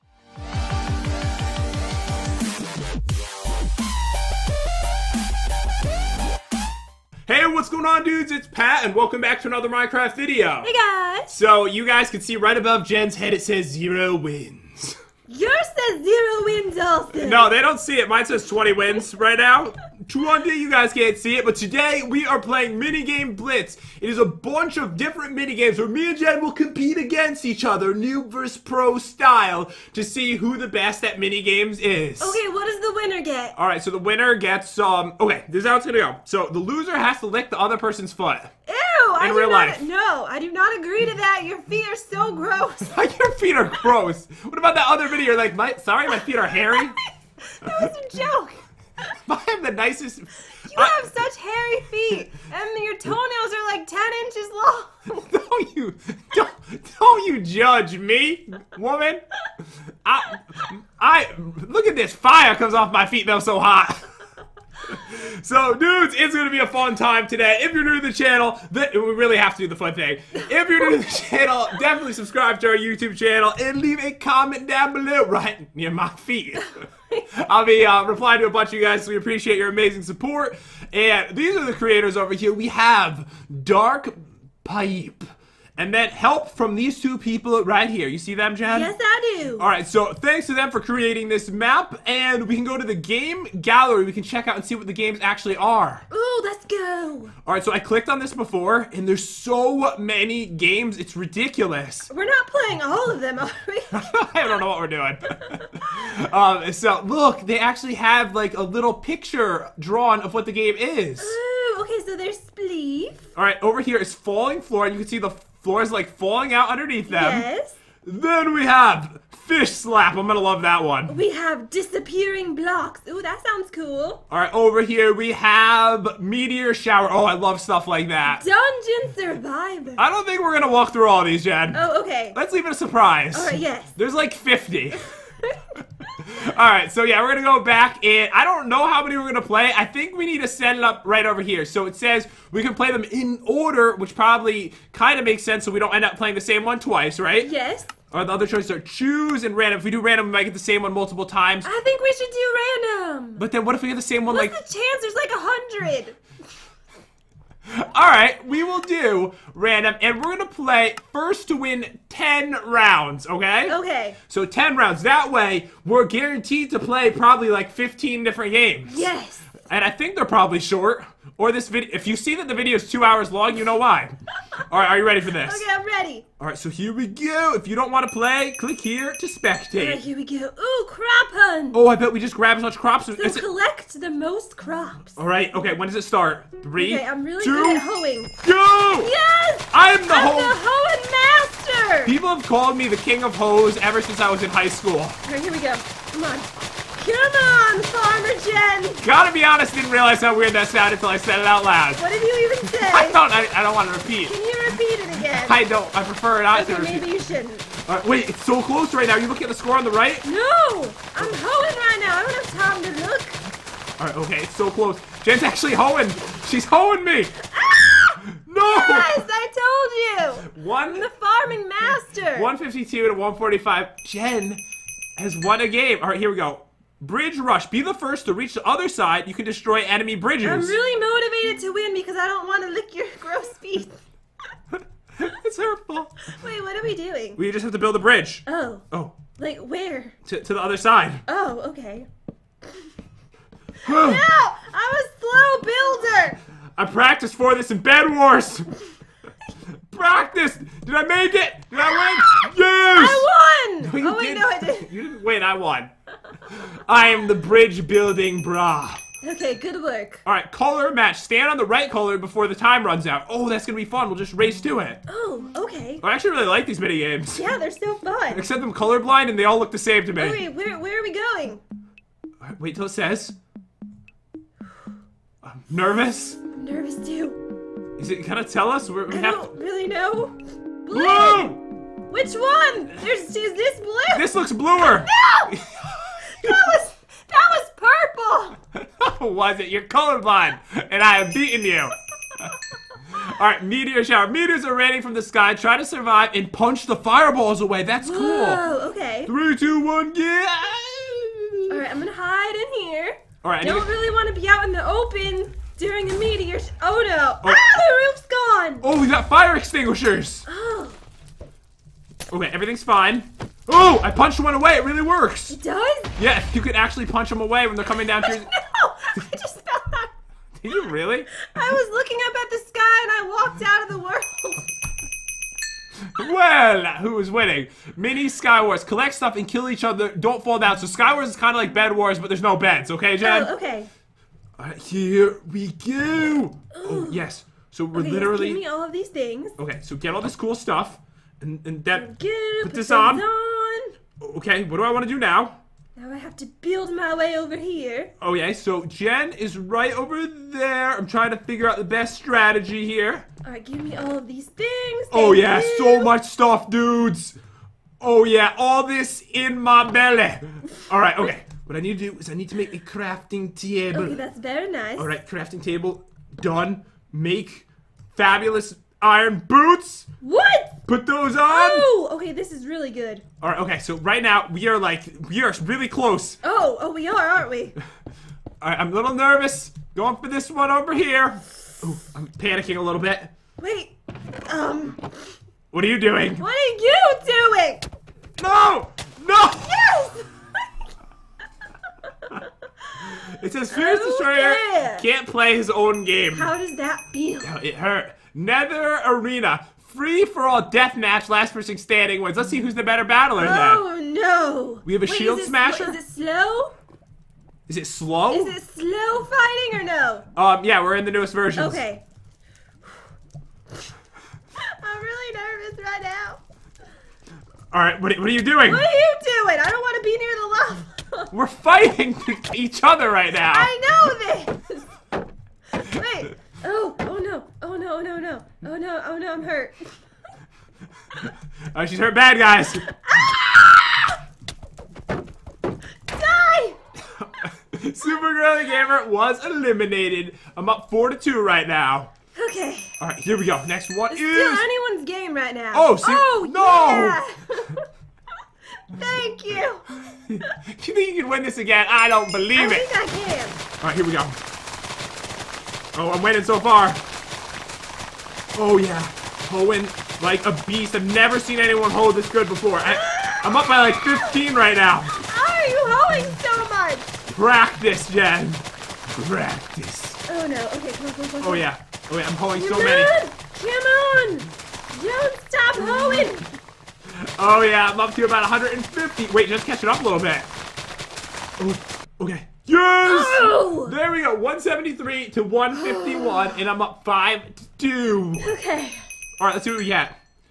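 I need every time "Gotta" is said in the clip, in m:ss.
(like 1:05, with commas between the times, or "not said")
3:19.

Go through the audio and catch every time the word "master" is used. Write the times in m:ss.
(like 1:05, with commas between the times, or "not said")
3:11, 3:41.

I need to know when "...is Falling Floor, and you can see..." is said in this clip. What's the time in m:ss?
1:53.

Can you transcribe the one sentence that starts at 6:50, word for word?
Um, yeah, we're in the newest version.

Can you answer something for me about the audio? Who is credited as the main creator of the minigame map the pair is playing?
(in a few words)
Dark Pipe.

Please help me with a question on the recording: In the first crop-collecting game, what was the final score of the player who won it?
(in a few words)
152.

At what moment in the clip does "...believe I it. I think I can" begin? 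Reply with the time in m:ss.
7:32.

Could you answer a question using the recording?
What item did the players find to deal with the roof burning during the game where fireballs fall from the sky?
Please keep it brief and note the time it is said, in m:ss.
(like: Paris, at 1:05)
Fire extinguishers, at 5:09.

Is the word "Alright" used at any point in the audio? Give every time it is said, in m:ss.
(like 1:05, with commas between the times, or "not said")
0:33, 2:37, 3:34, 5:53, 6:00, 6:04.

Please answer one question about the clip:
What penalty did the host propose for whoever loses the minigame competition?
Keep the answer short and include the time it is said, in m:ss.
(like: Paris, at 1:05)
Lick the other person's foot, at 0:37.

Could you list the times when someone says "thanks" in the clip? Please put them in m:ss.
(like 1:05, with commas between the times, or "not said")
1:30, 7:28.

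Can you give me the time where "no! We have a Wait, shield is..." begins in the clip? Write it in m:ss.
6:44.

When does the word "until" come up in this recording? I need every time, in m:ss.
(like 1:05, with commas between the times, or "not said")
3:21.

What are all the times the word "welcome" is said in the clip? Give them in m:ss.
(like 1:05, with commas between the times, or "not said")
0:08.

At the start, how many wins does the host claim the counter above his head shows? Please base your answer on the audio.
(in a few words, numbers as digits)
20.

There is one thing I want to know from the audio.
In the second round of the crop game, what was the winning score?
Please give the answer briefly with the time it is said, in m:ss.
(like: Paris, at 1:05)
173, at 8:04.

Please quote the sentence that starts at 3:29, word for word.
You looking at the score on the right?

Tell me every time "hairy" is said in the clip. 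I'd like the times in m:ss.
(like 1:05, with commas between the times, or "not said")
0:46, 0:51.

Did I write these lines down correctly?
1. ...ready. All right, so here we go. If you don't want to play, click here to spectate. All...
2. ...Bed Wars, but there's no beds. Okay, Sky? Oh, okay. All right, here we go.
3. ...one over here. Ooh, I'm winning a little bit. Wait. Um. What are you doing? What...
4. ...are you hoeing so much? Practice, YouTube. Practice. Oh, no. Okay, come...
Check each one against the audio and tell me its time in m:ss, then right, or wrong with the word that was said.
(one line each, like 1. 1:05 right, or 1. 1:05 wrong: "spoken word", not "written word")
1. 2:55 right
2. 5:31 wrong: "Jen", not "Sky"
3. 6:20 wrong: "panicking", not "winning"
4. 7:45 wrong: "Jen", not "YouTube".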